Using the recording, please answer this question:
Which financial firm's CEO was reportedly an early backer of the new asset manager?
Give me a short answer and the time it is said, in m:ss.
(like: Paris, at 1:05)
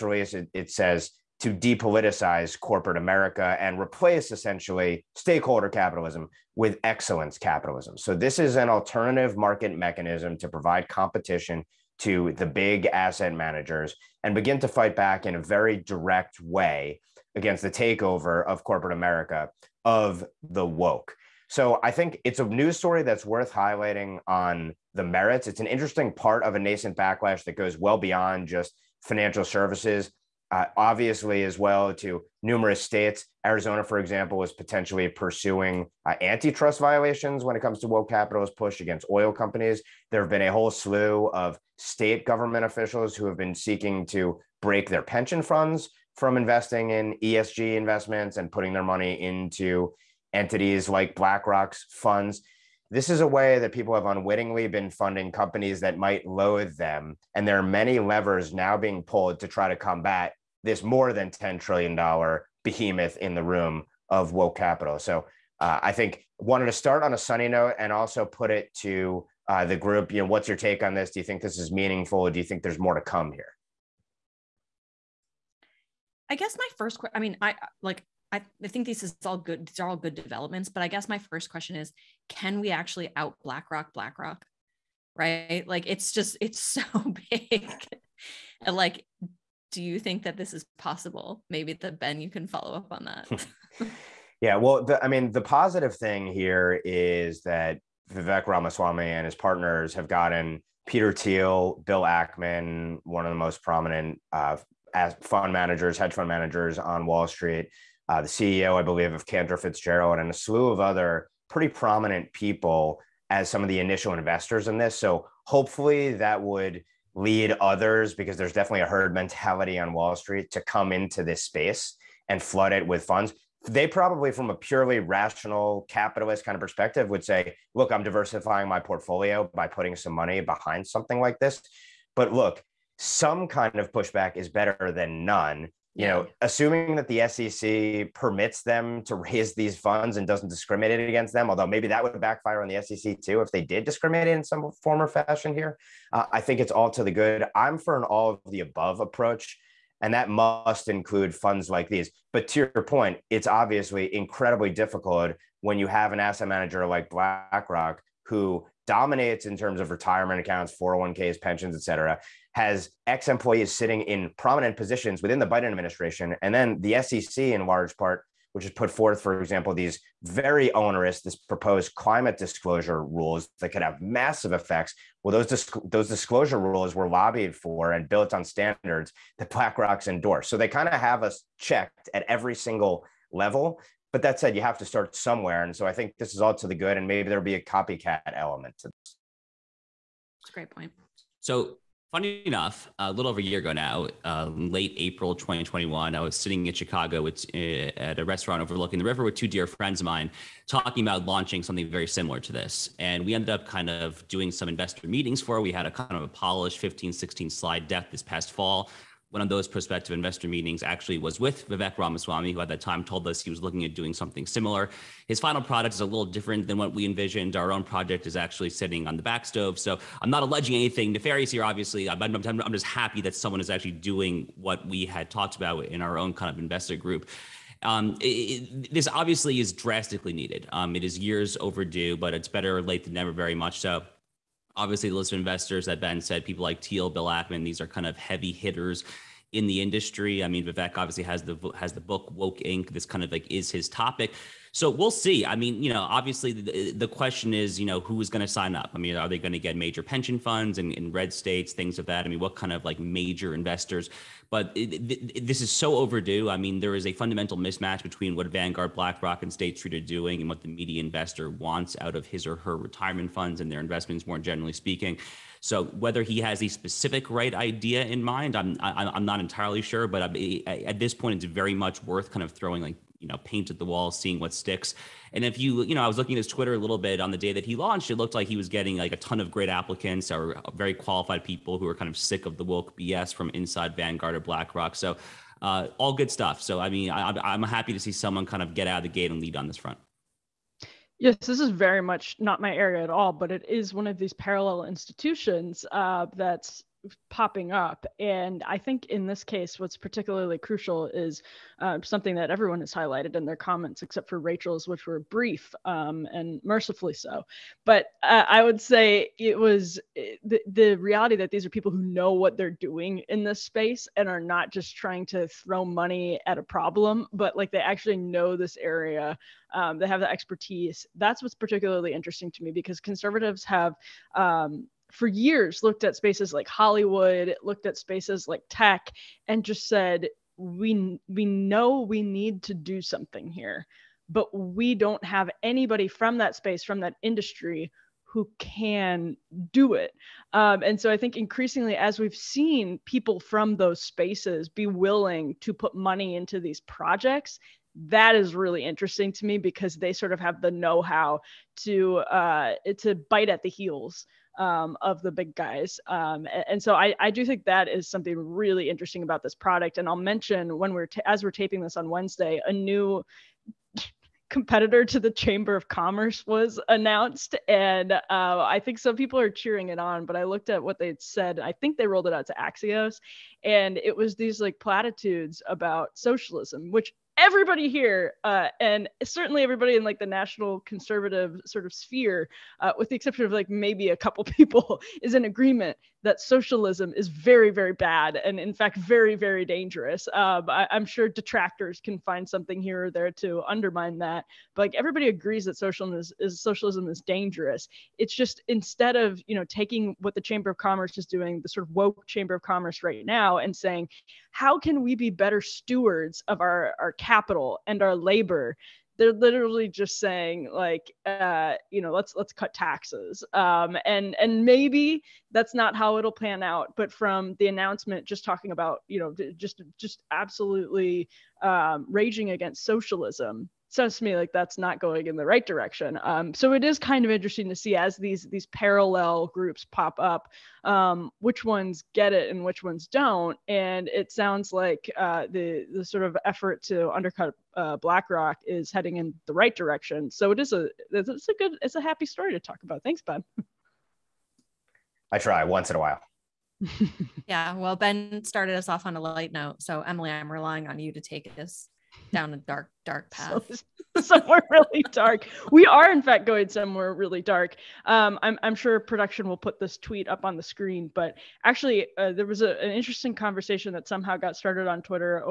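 Cantor Fitzgerald, at 1:49.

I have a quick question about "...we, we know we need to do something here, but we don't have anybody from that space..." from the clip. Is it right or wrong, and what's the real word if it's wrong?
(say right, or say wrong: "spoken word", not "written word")
right.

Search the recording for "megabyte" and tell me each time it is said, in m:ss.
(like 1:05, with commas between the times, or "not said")
not said.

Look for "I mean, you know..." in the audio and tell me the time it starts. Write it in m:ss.
4:05.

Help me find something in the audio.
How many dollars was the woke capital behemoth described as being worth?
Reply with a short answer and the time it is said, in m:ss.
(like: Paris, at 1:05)
more than $10 trillion, at 1:00.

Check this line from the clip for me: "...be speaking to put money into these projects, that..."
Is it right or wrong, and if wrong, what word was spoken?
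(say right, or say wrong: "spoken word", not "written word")
wrong: "willing", not "speaking".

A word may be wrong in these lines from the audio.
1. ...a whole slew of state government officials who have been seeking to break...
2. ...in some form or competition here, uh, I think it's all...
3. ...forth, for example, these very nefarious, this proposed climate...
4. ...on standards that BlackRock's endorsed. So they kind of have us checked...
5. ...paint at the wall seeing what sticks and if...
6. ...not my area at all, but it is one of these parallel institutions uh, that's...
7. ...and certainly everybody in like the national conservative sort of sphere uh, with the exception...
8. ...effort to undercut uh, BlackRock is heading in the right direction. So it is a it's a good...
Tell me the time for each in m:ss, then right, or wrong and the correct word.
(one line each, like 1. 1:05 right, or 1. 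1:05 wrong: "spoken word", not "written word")
1. 0:40 right
2. 2:24 wrong: "fashion", not "competition"
3. 2:48 wrong: "onerous", not "nefarious"
4. 2:58 right
5. 4:33 right
6. 4:52 right
7. 6:18 right
8. 7:16 right.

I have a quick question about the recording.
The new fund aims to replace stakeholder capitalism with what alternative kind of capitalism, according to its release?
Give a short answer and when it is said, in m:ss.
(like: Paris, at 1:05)
excellence capitalism, at 0:06.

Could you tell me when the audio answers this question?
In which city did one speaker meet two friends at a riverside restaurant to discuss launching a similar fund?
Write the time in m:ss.
3:16.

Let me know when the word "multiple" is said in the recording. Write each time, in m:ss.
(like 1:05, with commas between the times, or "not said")
not said.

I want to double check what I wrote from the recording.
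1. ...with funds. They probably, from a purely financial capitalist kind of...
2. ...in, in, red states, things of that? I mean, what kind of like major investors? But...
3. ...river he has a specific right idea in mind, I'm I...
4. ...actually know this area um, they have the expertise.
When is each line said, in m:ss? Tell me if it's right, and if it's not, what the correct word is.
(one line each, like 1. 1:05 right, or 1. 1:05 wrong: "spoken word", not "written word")
1. 2:02 wrong: "rational", not "financial"
2. 4:10 right
3. 4:25 wrong: "whether", not "river"
4. 5:17 right.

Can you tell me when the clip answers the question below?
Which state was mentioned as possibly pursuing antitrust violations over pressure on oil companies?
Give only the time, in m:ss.
0:33.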